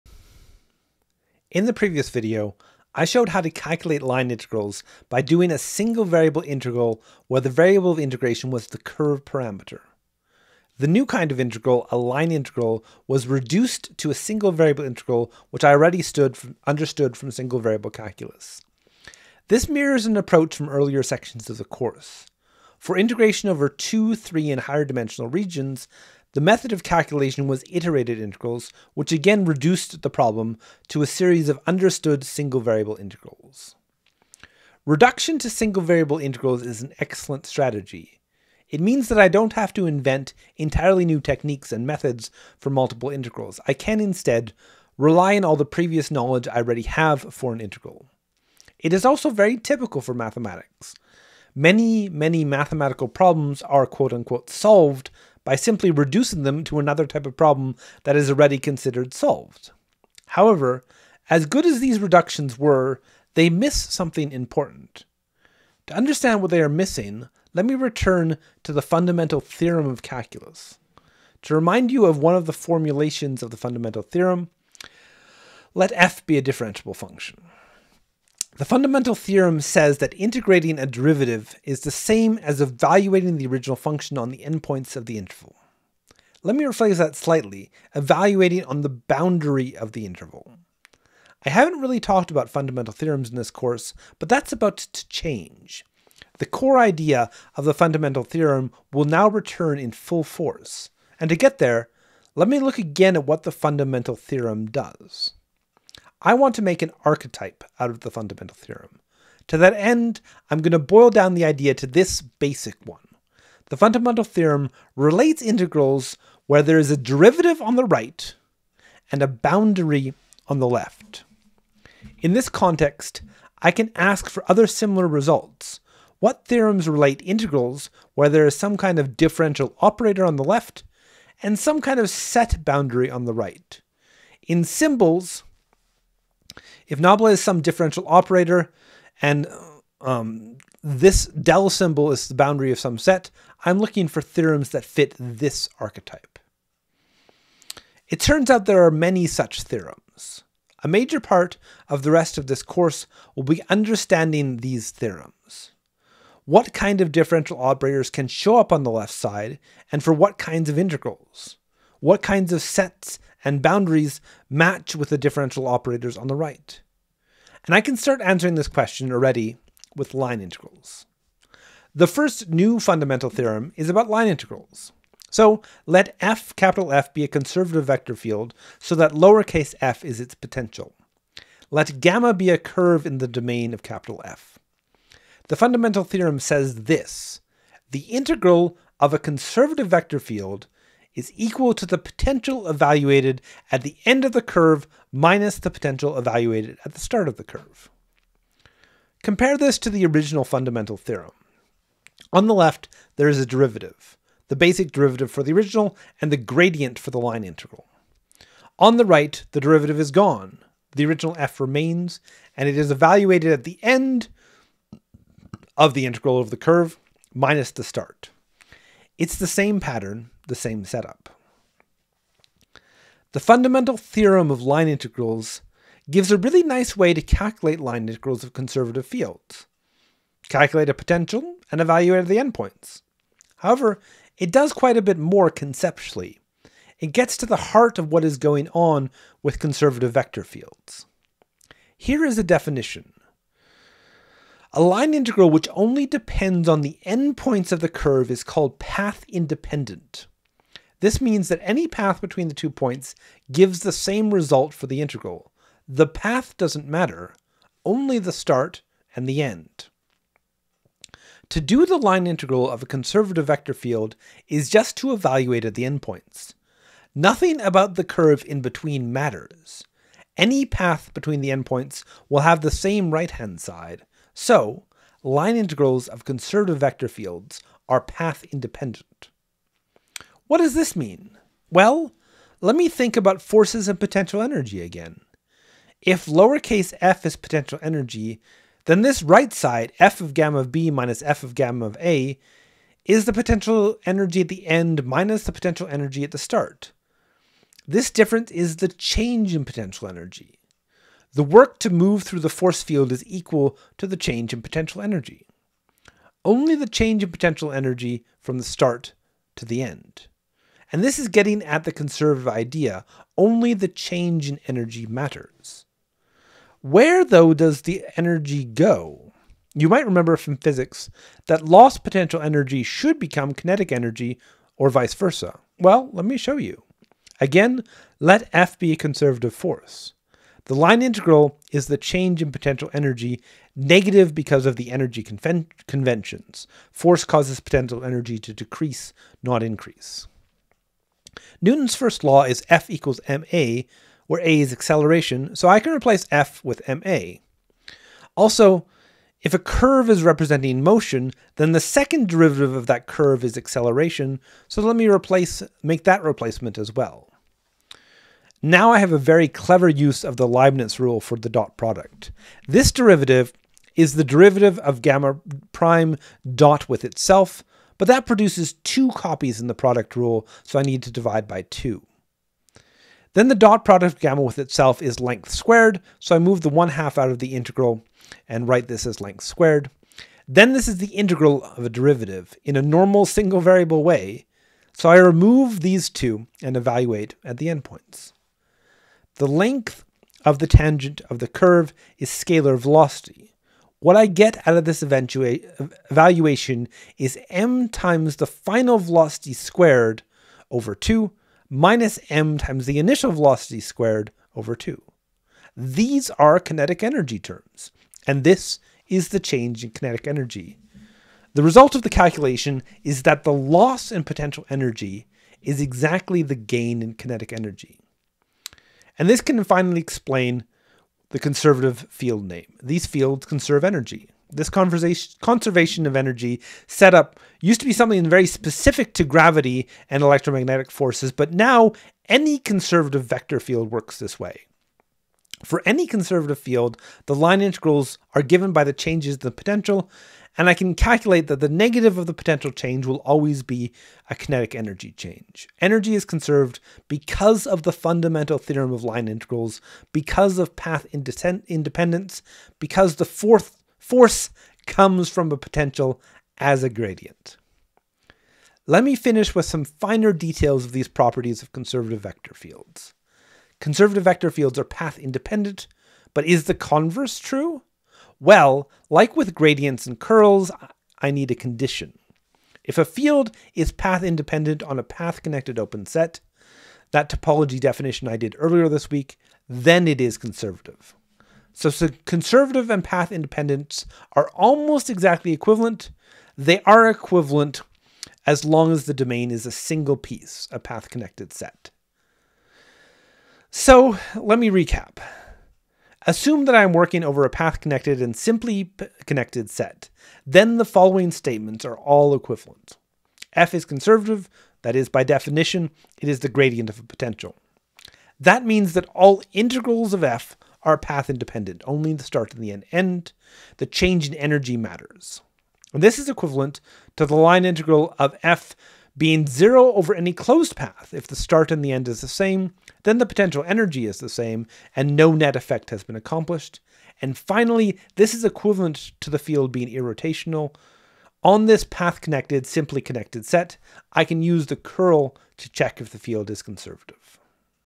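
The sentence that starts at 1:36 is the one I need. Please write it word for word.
The core idea of the fundamental theorem will now return in full force.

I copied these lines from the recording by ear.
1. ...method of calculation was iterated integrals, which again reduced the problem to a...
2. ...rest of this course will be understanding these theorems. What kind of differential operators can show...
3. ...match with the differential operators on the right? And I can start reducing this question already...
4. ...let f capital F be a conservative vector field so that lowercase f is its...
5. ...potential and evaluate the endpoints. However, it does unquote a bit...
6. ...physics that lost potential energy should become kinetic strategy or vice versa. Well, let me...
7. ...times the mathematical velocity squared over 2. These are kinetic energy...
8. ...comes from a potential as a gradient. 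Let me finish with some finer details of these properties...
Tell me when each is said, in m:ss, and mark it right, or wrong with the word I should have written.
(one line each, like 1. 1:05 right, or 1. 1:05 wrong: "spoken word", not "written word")
1. 0:26 right
2. 2:32 right
3. 2:44 wrong: "answering", not "reducing"
4. 2:55 right
5. 3:50 wrong: "quite", not "unquote"
6. 5:20 wrong: "energy", not "strategy"
7. 6:42 wrong: "initial", not "mathematical"
8. 7:34 right.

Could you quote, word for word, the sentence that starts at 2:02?
In this context, I can ask for other similar results.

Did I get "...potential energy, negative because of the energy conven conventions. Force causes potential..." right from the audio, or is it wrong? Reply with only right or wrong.
right.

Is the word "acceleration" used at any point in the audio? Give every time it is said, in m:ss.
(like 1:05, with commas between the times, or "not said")
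5:44, 5:53.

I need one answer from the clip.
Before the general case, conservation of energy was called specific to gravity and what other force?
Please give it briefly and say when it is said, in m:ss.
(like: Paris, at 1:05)
electromagnetic, at 7:10.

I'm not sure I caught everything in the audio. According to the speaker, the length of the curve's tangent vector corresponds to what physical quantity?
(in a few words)
scalar velocity.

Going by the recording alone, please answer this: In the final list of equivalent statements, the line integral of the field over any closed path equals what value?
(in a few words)
0.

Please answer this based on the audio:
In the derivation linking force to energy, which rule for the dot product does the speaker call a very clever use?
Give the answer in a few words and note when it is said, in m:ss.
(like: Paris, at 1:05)
Leibniz rule, at 6:00.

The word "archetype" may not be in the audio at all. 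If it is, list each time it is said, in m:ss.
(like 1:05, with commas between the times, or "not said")
1:47, 2:25.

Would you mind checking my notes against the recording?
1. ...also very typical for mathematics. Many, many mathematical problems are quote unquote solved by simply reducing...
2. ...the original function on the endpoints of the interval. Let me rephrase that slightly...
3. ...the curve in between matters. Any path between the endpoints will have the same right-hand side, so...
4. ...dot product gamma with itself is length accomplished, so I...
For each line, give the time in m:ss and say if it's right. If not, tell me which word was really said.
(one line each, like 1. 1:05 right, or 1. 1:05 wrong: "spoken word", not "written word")
1. 0:49 right
2. 1:23 right
3. 4:27 right
4. 6:13 wrong: "squared", not "accomplished".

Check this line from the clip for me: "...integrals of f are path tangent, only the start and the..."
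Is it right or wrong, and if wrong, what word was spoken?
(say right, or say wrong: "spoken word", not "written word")
wrong: "independent", not "tangent".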